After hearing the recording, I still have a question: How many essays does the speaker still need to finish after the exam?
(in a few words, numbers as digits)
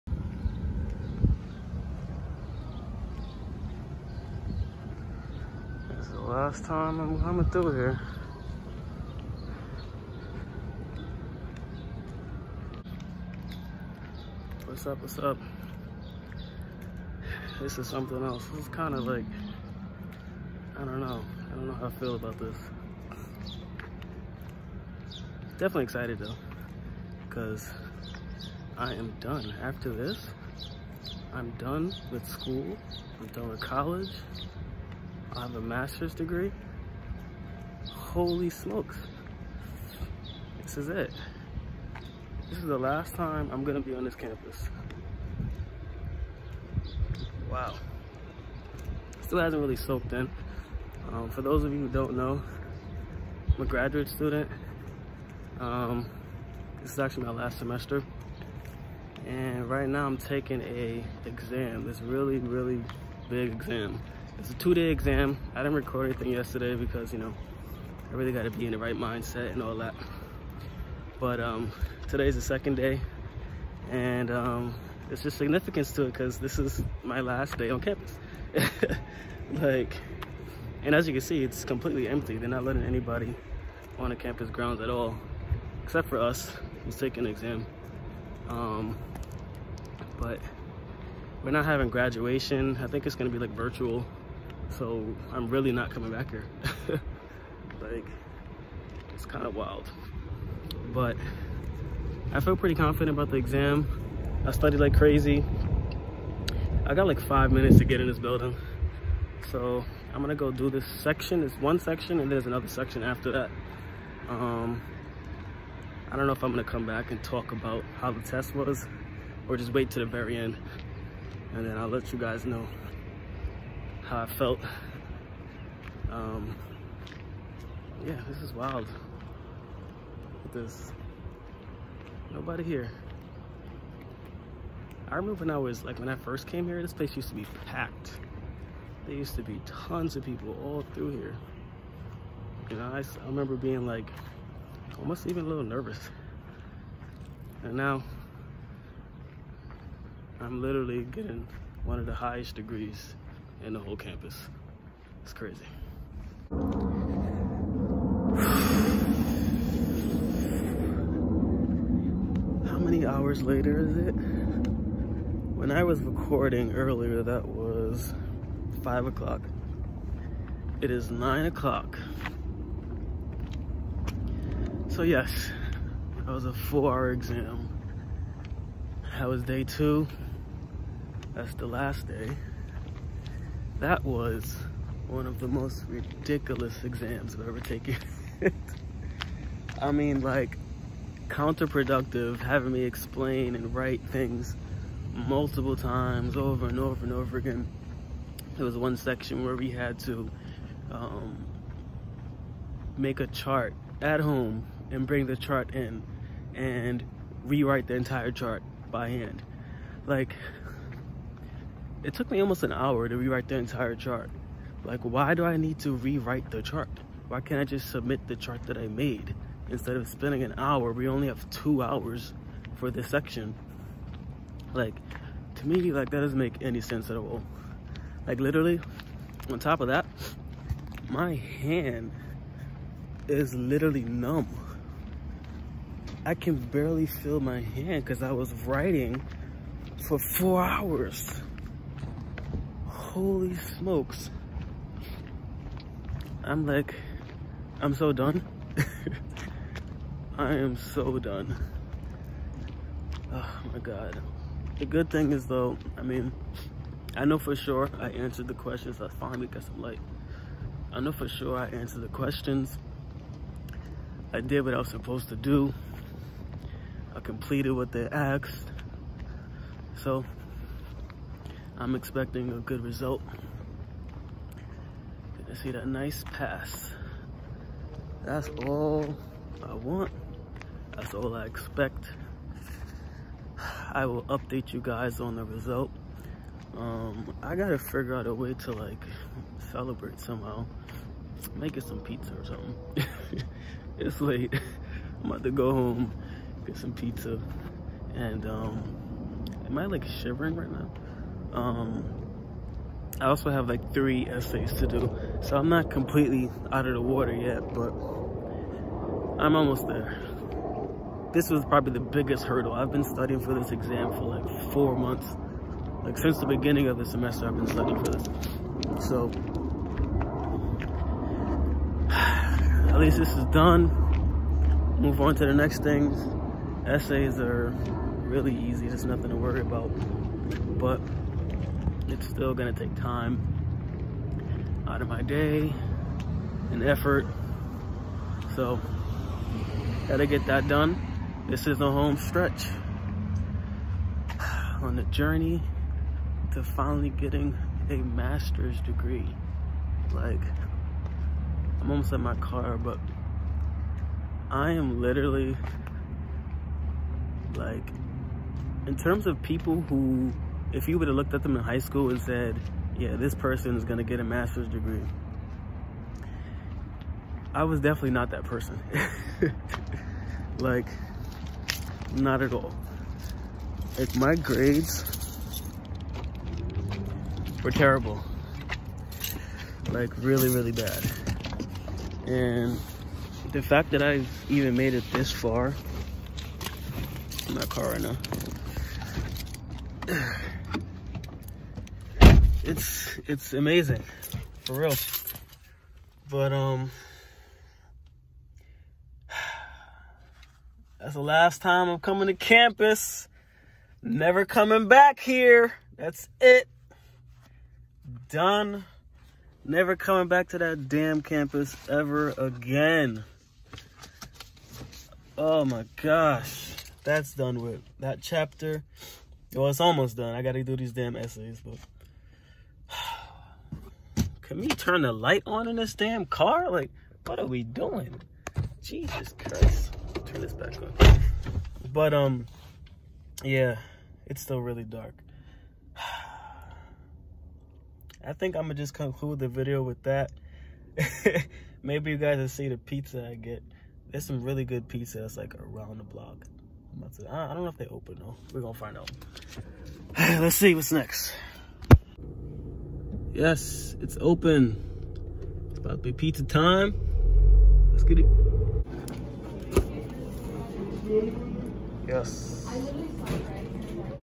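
3.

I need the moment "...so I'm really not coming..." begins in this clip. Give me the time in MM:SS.
01:34.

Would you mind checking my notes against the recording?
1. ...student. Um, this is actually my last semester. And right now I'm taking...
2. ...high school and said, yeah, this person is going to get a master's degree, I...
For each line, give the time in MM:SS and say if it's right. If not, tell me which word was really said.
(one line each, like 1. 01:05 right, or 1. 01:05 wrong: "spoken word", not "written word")
1. 00:54 right
2. 06:01 right.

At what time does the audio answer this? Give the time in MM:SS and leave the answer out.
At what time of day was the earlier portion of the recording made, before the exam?
02:47.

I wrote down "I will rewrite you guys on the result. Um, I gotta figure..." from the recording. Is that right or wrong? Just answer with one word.
wrong.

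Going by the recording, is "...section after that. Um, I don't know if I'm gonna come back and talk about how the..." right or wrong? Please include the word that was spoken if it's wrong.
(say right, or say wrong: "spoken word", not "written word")
right.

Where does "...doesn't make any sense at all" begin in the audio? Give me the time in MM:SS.
03:46.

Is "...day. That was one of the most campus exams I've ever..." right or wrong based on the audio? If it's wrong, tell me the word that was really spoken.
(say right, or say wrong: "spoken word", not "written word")
wrong: "ridiculous", not "campus".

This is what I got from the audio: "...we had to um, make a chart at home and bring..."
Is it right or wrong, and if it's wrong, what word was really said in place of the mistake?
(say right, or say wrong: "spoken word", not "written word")
right.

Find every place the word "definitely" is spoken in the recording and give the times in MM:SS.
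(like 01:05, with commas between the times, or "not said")
00:25, 06:07.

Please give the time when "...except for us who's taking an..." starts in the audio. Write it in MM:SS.
01:25.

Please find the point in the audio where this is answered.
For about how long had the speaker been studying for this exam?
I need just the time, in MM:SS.
05:14.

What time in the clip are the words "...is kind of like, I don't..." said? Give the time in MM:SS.
00:18.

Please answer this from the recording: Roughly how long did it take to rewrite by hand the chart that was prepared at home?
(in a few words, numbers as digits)
almost an hour.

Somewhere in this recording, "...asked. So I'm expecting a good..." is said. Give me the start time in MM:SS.
04:28.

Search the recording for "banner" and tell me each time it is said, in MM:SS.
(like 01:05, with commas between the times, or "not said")
not said.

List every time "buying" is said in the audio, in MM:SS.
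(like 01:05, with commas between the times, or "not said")
not said.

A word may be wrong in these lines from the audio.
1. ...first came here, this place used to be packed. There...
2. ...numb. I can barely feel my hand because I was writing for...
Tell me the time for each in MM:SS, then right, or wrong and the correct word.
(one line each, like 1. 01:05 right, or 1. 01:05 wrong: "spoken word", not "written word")
1. 02:16 right
2. 03:54 right.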